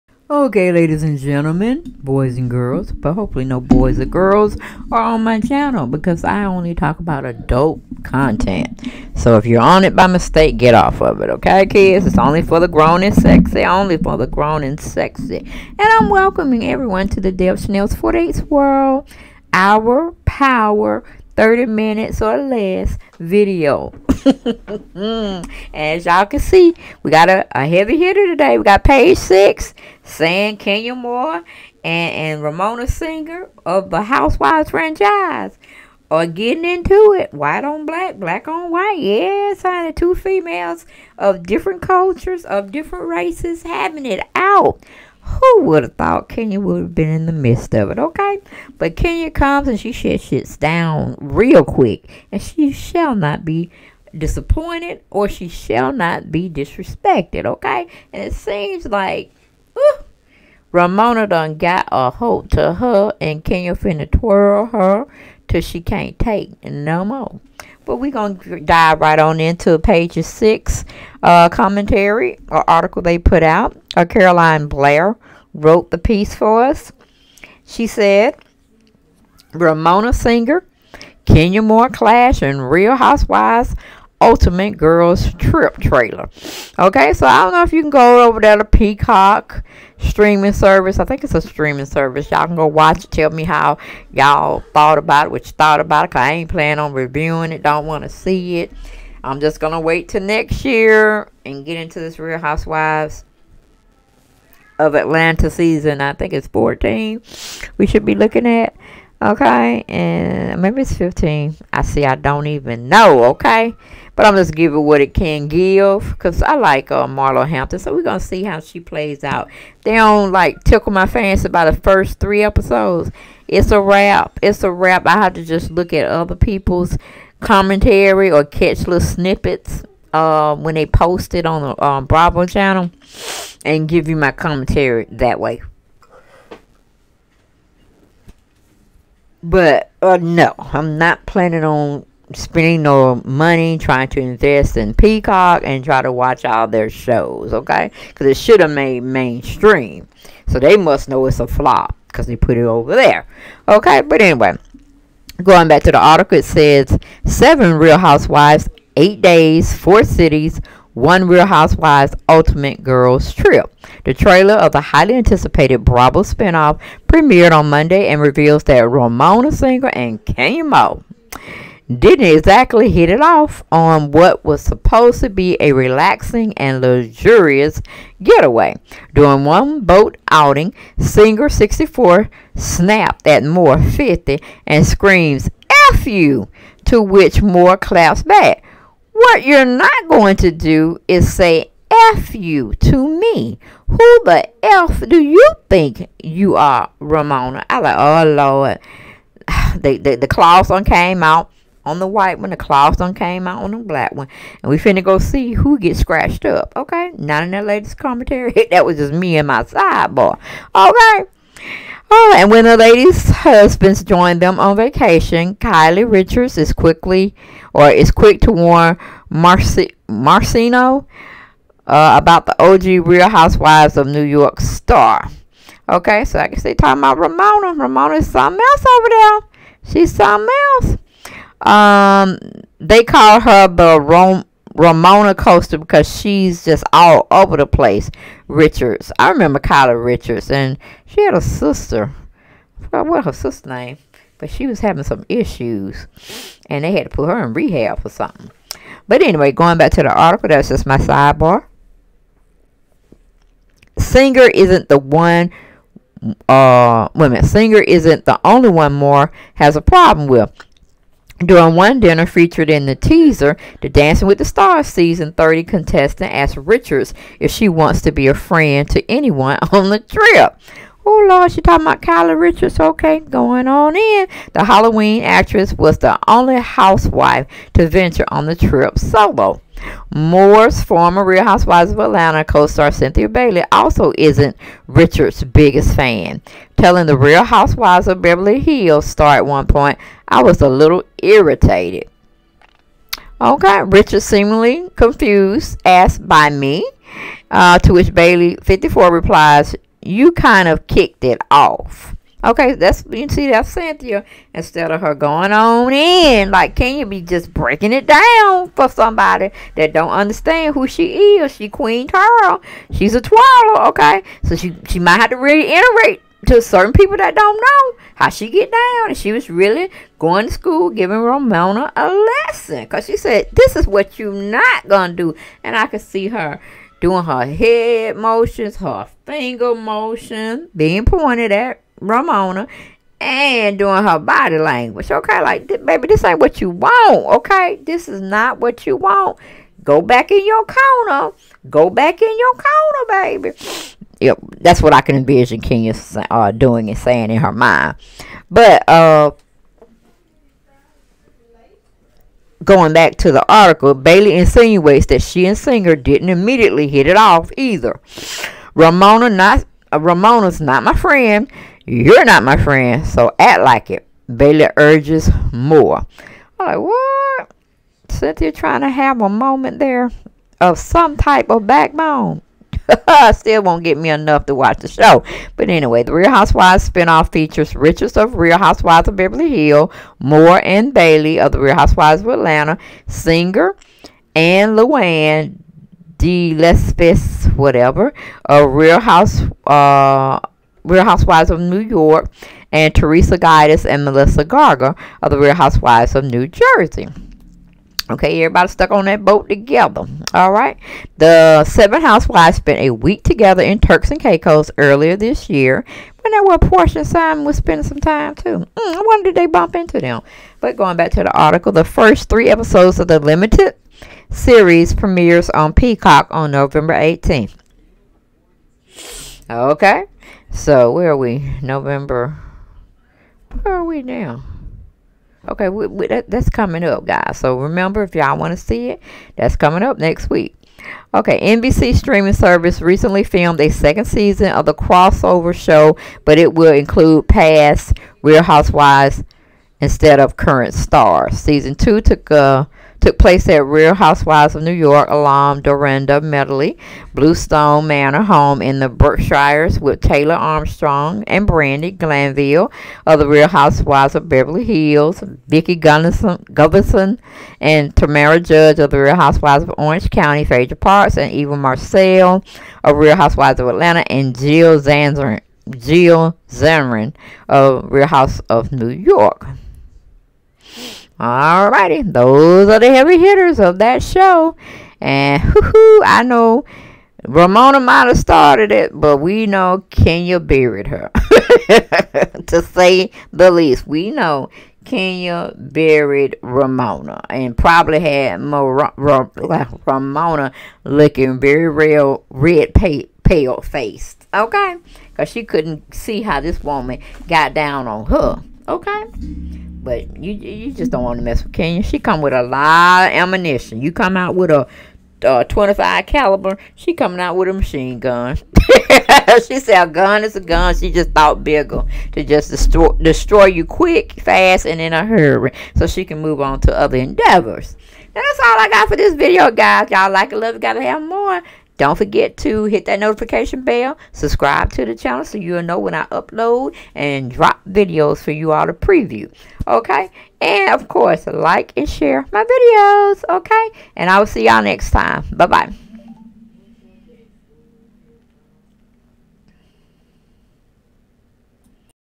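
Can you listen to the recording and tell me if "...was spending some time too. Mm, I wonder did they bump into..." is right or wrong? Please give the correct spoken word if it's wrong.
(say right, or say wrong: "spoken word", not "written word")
right.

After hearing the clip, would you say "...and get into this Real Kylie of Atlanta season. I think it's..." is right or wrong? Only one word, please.
wrong.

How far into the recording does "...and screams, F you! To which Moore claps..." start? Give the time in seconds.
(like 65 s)
184 s.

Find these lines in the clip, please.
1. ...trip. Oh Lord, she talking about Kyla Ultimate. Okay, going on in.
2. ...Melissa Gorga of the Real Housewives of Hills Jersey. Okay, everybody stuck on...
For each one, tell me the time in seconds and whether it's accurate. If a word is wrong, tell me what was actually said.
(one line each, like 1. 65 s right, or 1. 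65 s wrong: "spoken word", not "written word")
1. 269 s wrong: "Richards", not "Ultimate"
2. 394 s wrong: "New", not "Hills".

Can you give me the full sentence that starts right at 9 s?
So if you're on it by mistake, get off of it, okay, kids?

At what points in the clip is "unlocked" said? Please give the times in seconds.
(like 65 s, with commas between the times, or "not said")
not said.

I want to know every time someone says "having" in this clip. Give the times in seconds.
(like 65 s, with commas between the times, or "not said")
43 s, 244 s.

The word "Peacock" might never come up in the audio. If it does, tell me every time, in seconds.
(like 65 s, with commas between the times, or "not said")
88 s, 144 s, 415 s.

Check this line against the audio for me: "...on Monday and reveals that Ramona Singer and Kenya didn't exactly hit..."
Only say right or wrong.
right.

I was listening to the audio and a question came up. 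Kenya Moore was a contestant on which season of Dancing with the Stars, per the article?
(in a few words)
Season 30.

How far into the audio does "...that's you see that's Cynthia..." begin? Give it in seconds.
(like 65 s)
302 s.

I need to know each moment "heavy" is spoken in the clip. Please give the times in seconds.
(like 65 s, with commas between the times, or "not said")
27 s, 472 s.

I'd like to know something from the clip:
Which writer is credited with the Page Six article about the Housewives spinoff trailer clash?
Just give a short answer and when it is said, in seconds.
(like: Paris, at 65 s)
Caroline Blair, at 74 s.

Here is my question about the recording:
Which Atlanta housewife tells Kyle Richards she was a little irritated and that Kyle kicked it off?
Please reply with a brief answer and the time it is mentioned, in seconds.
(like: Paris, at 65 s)
Cynthia Bailey, at 282 s.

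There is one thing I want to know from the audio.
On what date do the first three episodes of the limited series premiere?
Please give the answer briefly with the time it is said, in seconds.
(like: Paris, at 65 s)
November 18th, at 416 s.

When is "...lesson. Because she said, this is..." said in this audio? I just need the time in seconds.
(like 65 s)
322 s.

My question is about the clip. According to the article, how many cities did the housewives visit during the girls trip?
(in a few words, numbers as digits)
4.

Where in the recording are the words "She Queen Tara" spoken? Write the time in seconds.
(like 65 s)
311 s.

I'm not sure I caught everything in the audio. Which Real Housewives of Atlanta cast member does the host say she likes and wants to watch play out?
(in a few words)
Marlo Hampton.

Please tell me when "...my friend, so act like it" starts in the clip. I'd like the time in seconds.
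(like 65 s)
362 s.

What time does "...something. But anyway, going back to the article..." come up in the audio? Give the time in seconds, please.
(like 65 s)
248 s.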